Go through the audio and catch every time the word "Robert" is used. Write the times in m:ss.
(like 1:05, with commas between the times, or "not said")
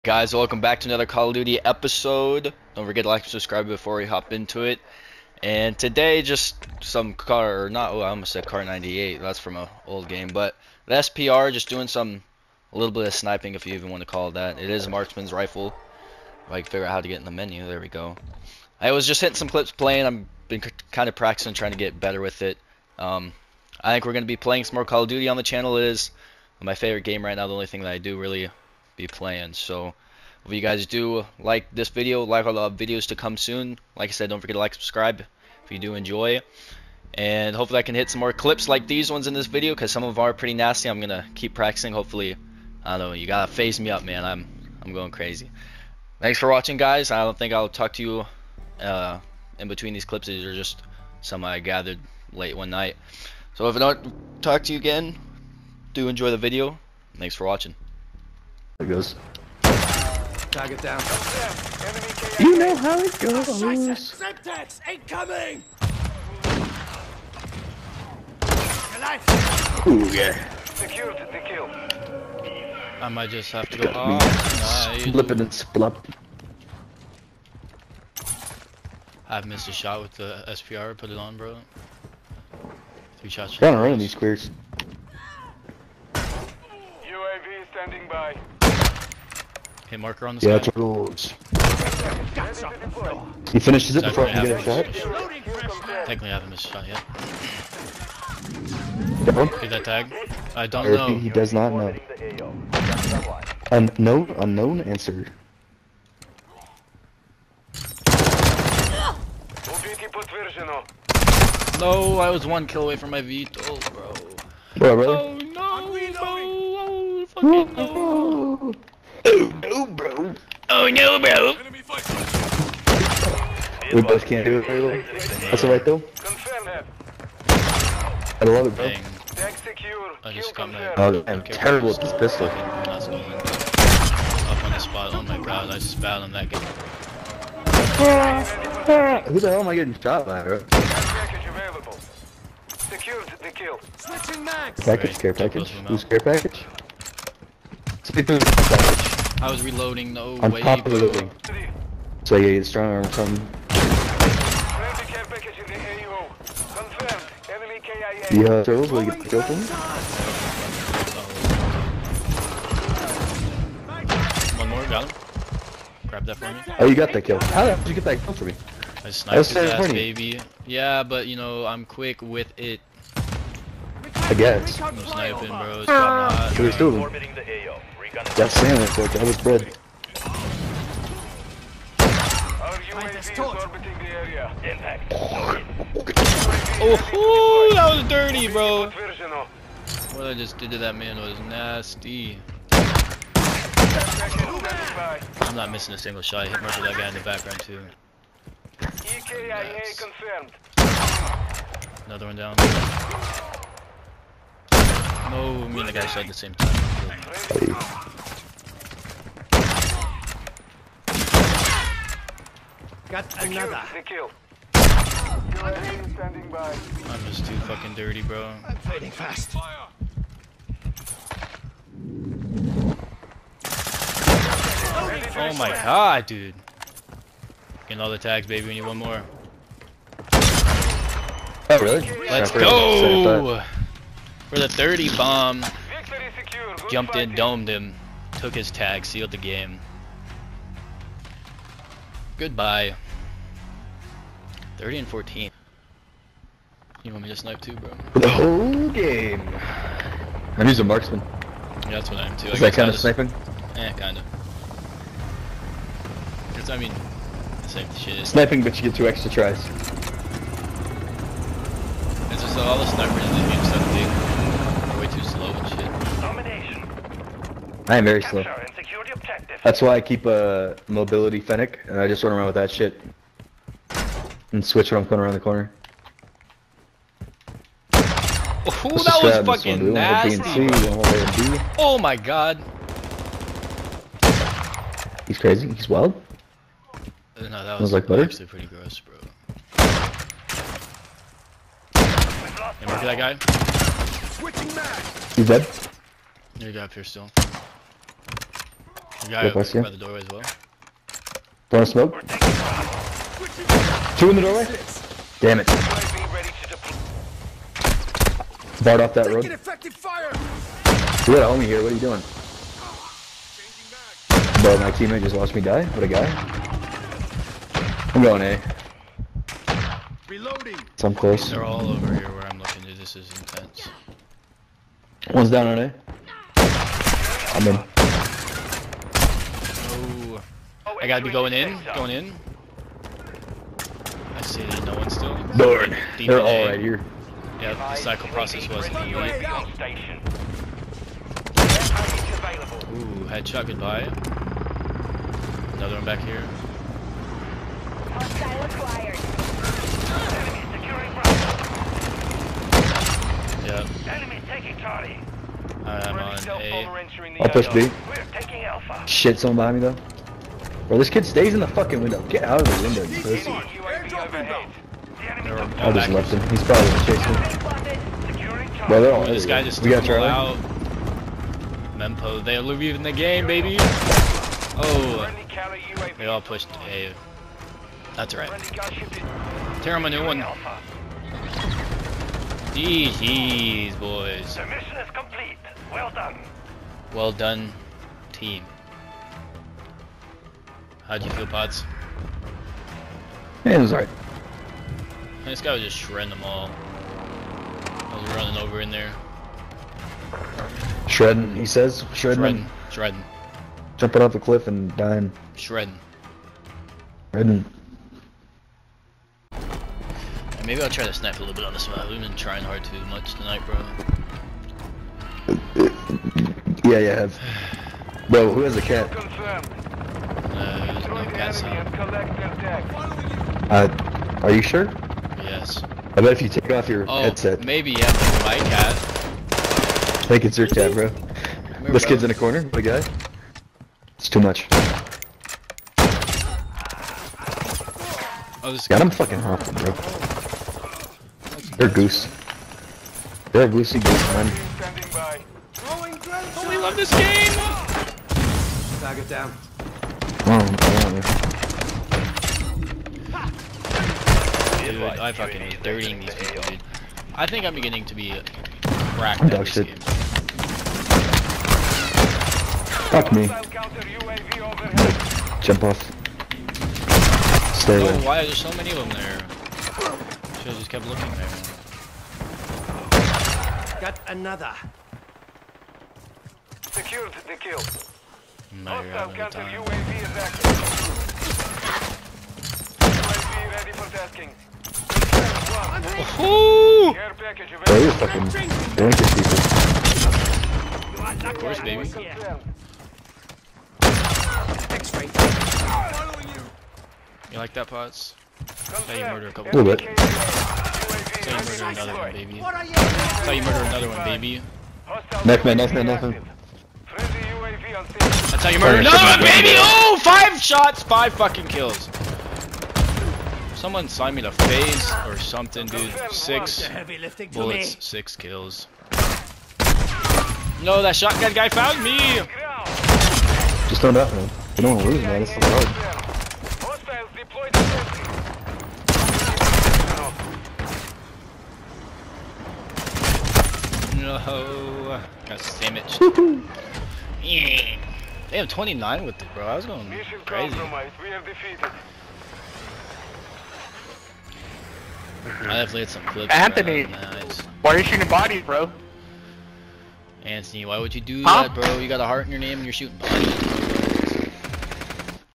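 not said.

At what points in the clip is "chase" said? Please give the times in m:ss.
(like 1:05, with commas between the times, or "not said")
6:07.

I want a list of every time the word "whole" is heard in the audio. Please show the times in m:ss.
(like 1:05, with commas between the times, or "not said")
4:08.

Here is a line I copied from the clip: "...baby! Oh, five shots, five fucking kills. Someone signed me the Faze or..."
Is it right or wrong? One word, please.
right.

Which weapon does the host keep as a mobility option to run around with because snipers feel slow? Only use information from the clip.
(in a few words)
Fennec.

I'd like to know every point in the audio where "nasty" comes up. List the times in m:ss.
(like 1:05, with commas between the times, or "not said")
0:40, 3:11, 4:39.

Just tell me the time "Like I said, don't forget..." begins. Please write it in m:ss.
0:33.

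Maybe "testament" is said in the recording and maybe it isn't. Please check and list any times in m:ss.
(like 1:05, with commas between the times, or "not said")
not said.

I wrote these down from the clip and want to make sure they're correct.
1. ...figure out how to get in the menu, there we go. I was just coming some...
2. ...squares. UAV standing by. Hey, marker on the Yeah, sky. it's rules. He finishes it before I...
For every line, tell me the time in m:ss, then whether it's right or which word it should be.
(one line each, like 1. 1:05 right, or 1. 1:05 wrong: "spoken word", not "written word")
1. 0:16 wrong: "hitting", not "coming"
2. 1:24 right.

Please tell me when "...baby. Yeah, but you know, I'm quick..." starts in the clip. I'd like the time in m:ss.
2:49.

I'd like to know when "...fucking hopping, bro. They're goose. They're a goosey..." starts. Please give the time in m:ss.
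7:19.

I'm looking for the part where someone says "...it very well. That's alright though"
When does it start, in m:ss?
2:04.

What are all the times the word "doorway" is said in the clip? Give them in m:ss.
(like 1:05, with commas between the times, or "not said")
4:59, 5:04.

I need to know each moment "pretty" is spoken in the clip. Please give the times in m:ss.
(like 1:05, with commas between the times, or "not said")
0:40, 4:48.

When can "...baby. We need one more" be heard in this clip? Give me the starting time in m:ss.
3:48.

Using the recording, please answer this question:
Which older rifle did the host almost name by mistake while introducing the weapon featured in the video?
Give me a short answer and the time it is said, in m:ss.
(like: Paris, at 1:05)
Kar 98, at 0:08.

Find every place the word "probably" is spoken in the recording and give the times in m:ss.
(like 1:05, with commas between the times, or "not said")
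6:06.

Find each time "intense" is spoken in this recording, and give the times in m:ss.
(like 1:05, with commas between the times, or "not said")
5:23.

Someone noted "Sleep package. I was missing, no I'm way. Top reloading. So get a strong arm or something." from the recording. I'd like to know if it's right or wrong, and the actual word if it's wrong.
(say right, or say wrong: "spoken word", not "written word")
wrong: "reloading", not "missing".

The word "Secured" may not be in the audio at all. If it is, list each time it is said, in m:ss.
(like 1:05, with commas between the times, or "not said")
1:10, 2:22, 7:56.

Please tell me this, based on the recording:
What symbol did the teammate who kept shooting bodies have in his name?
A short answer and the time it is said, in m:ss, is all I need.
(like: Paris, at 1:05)
A heart, at 9:12.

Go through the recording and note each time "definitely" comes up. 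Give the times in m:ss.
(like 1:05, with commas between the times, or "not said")
9:05.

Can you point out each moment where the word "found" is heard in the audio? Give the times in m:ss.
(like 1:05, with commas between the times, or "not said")
2:15, 8:41.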